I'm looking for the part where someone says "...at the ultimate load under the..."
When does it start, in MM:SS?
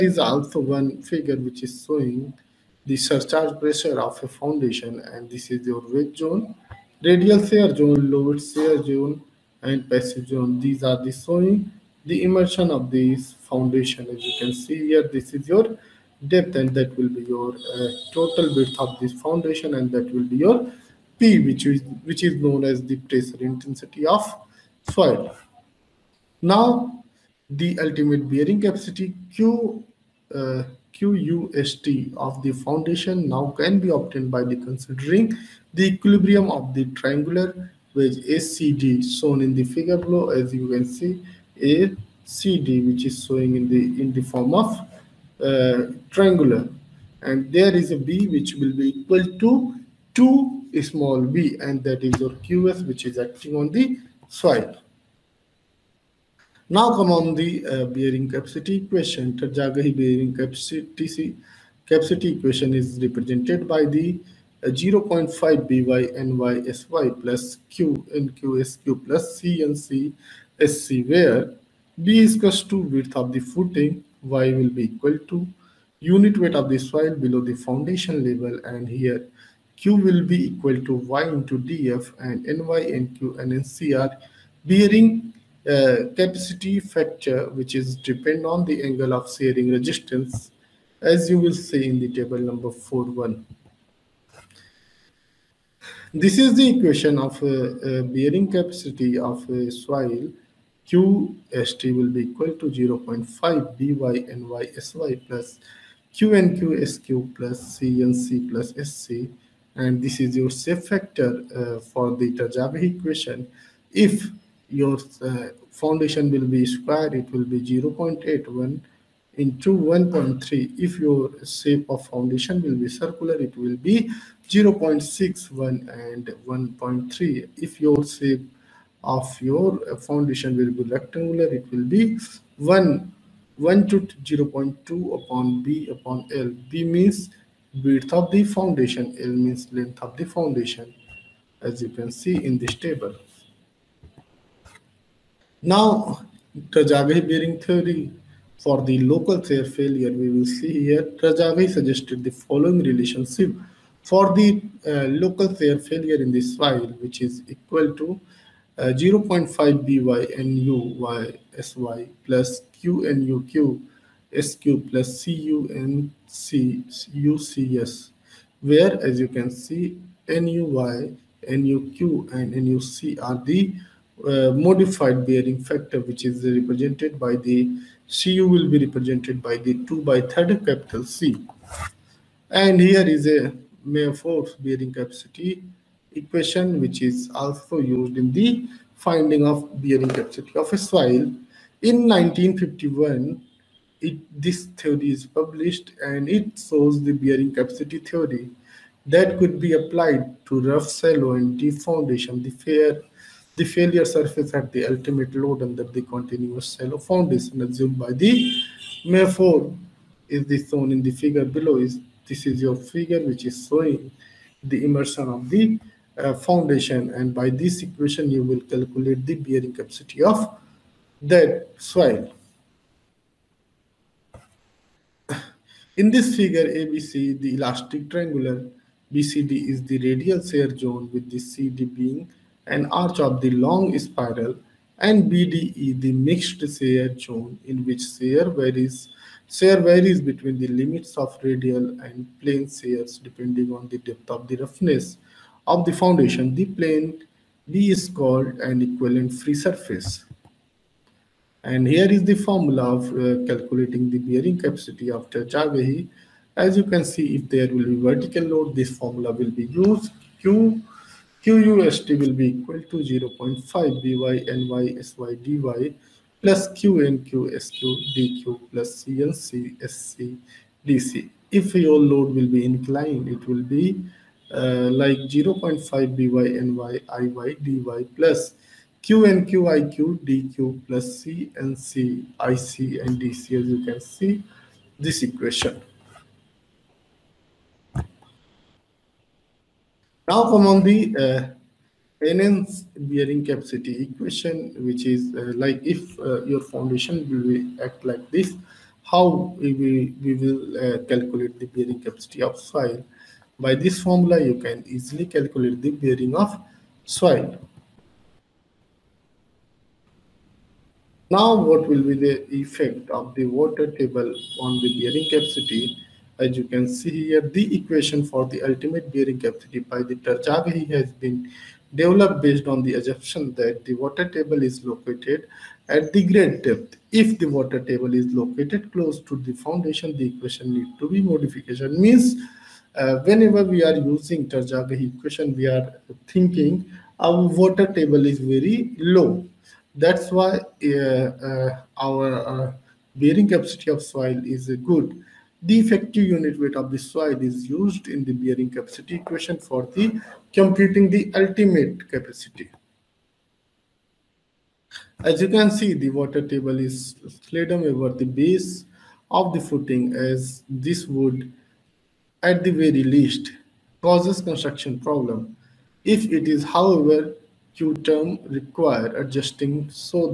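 03:24.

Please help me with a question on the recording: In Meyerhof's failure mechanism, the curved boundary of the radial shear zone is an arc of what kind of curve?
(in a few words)
log spiral.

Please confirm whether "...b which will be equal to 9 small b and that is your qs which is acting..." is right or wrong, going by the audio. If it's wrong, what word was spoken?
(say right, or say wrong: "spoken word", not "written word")
wrong: "2", not "9".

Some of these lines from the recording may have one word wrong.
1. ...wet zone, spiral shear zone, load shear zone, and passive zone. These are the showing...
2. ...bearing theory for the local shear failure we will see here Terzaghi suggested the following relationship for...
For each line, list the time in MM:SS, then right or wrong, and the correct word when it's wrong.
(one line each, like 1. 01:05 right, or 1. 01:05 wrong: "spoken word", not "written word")
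1. 00:05 wrong: "radial", not "spiral"
2. 02:27 right.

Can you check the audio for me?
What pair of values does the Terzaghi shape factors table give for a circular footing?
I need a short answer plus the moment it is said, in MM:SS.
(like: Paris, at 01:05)
0.61 and 1.3, at 02:04.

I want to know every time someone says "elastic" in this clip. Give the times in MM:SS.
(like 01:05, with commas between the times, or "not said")
03:47.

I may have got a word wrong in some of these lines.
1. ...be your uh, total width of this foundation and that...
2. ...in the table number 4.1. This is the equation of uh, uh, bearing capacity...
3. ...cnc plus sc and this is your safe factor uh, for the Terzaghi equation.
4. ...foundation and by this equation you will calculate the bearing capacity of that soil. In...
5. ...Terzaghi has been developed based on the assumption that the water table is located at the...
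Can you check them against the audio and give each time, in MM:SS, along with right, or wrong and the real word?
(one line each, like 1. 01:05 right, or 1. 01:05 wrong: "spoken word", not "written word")
1. 00:17 right
2. 01:31 right
3. 01:47 right
4. 03:36 right
5. 05:20 right.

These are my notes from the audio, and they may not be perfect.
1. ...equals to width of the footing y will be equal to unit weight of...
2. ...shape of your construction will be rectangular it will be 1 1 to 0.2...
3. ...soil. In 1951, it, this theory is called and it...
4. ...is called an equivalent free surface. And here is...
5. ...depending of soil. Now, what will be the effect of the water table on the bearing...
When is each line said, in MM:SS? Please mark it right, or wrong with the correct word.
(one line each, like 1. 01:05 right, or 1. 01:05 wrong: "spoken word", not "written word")
1. 01:12 right
2. 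02:08 wrong: "foundation", not "construction"
3. 03:10 wrong: "published", not "called"
4. 04:07 right
5. 05:05 wrong: "bearing", not "depending".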